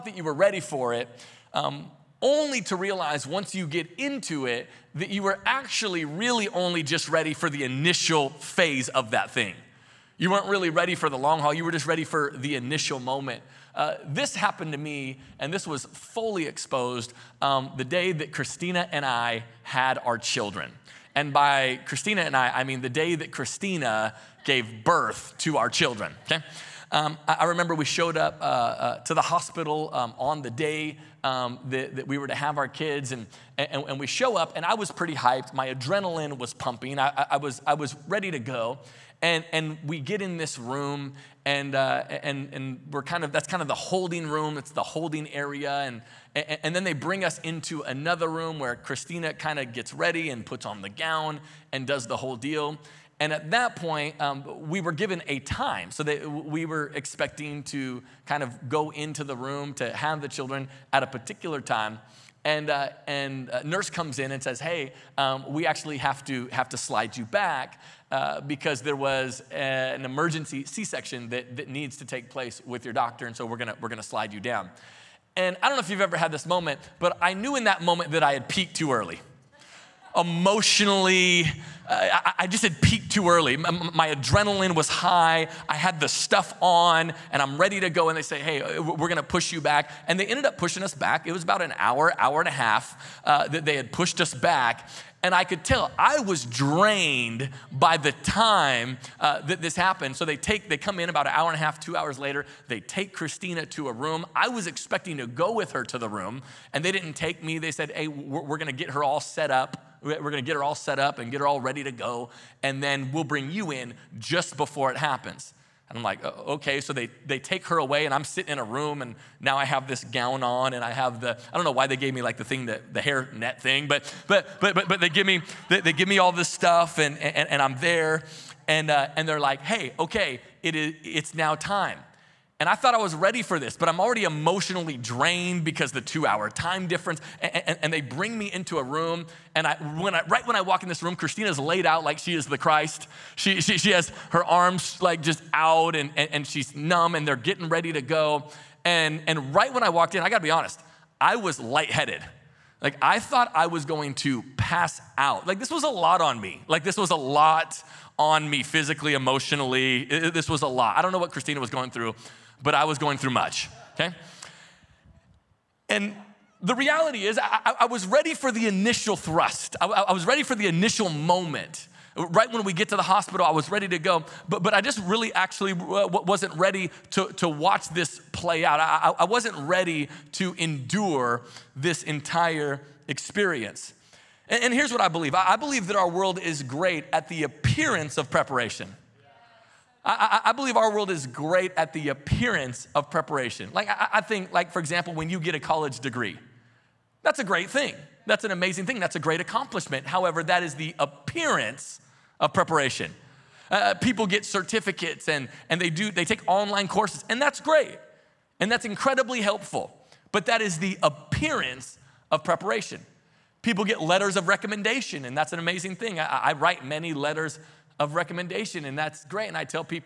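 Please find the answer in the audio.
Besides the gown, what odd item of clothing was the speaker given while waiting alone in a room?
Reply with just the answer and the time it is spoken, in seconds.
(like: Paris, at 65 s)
Hair net, at 123 s.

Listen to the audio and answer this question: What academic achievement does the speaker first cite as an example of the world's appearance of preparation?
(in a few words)
College degree.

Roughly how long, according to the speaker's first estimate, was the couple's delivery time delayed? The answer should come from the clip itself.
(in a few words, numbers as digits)
An hour and a half.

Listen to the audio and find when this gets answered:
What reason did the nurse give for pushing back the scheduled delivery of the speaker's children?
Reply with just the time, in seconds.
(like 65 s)
70 s.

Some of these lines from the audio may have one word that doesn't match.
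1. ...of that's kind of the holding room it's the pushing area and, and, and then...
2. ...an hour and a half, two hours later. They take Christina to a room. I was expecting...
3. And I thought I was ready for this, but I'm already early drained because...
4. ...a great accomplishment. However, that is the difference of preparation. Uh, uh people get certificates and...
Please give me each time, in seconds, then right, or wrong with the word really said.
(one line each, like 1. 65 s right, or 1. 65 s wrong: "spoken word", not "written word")
1. 43 s wrong: "holding", not "pushing"
2. 101 s right
3. 132 s wrong: "emotionally", not "early"
4. 199 s wrong: "appearance", not "difference".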